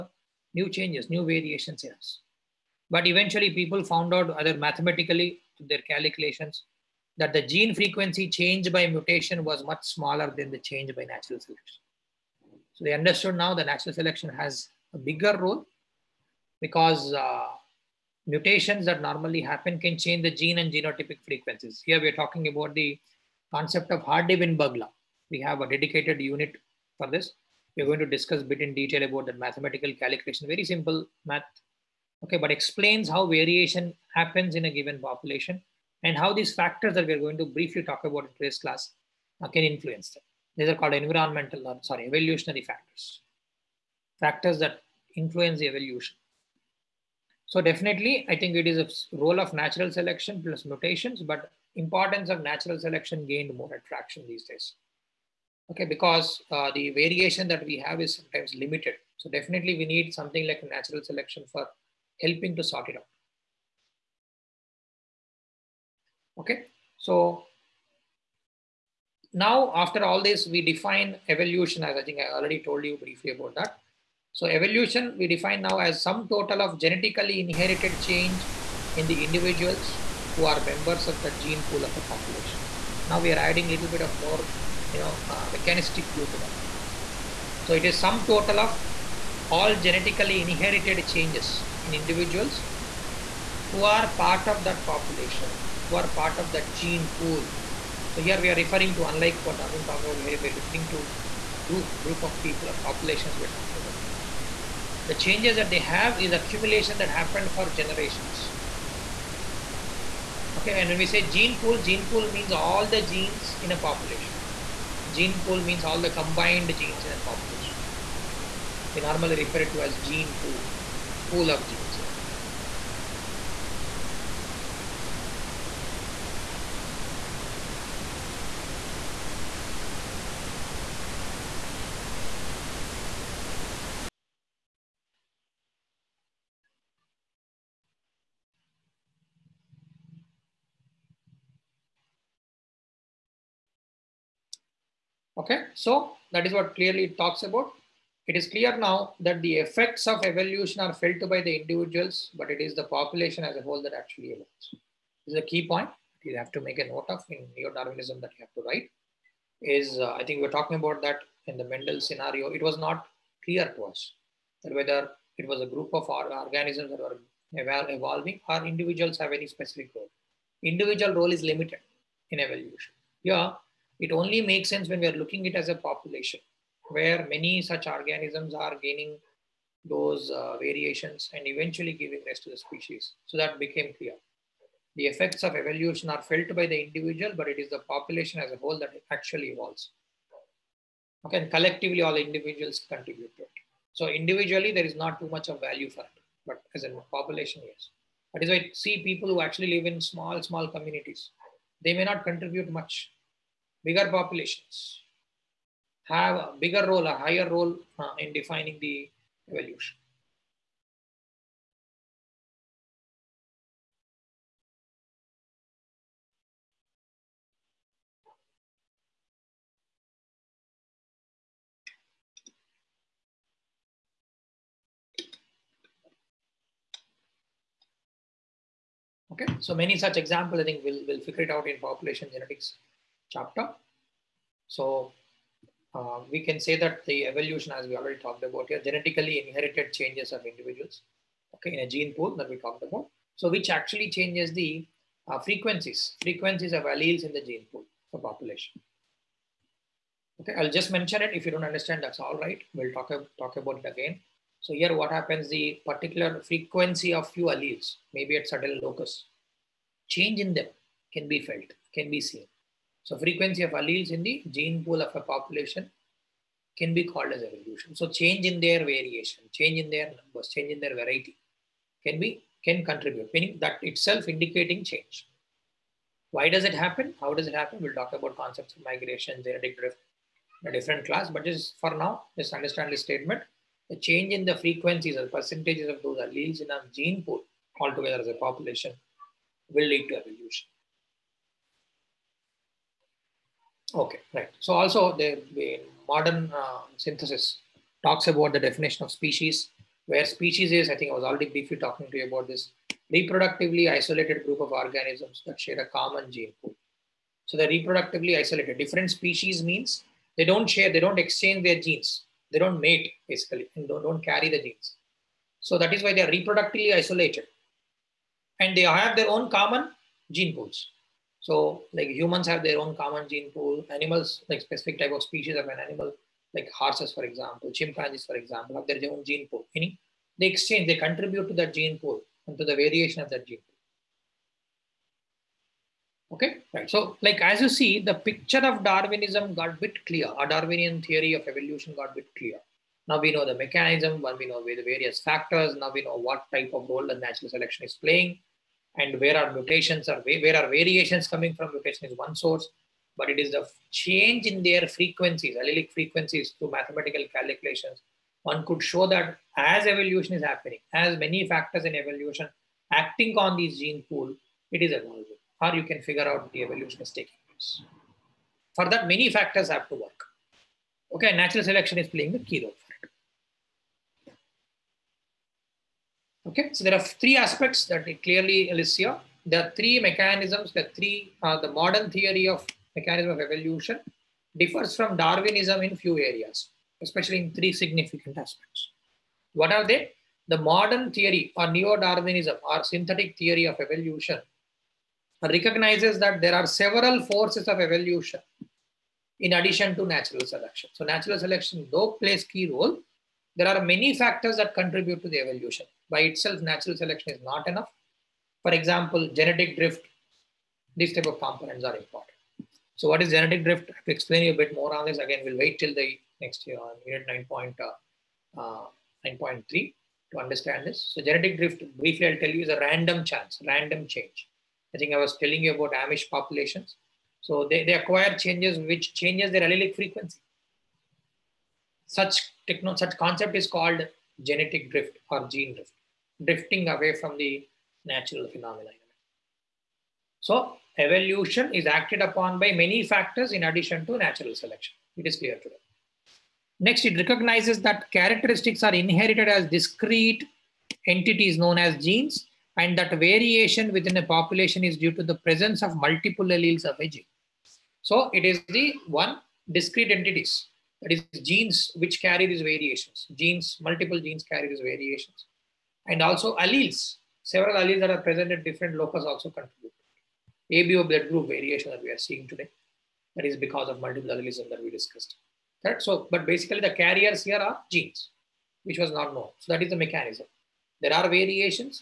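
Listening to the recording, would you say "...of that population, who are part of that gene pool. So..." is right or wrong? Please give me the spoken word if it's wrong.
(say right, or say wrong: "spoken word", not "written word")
right.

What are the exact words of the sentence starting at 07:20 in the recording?
So evolution is acted upon by many factors in addition to natural selection.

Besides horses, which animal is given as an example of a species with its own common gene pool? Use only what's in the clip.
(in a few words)
chimpanzees.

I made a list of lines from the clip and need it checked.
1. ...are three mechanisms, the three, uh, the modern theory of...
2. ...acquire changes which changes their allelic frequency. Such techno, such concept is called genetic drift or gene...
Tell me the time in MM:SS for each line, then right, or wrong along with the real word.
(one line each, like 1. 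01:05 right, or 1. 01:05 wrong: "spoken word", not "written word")
1. 06:19 right
2. 07:07 right.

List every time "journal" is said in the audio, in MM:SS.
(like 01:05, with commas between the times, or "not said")
not said.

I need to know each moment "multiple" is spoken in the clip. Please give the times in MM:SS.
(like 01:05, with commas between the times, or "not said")
07:35, 07:43, 07:53.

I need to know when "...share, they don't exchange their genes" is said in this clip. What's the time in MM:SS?
05:10.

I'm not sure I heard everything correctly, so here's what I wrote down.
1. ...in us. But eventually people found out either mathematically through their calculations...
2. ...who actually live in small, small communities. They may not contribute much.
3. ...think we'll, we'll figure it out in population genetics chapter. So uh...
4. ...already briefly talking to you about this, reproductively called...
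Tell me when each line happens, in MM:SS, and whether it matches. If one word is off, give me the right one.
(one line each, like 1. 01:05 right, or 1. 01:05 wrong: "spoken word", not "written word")
1. 00:01 right
2. 03:19 right
3. 03:50 right
4. 05:01 wrong: "isolated", not "called".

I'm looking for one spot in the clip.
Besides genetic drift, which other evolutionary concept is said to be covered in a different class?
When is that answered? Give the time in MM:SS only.
04:38.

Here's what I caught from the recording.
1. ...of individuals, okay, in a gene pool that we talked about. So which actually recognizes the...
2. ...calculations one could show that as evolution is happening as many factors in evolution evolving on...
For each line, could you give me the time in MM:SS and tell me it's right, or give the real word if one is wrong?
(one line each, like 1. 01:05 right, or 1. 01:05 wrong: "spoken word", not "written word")
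1. 04:00 wrong: "changes", not "recognizes"
2. 05:57 wrong: "acting", not "evolving".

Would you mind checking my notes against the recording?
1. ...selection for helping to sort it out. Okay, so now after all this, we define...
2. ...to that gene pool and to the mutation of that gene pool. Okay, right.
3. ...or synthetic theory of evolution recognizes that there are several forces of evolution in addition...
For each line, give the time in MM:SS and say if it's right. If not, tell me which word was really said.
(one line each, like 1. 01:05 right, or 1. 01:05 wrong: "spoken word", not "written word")
1. 01:01 right
2. 05:31 wrong: "variation", not "mutation"
3. 06:32 right.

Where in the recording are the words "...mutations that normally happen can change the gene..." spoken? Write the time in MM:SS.
00:18.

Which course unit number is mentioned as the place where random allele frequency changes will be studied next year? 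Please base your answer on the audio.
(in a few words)
9.3.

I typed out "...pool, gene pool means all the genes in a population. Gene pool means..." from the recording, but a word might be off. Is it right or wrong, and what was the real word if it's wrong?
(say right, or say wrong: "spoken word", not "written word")
right.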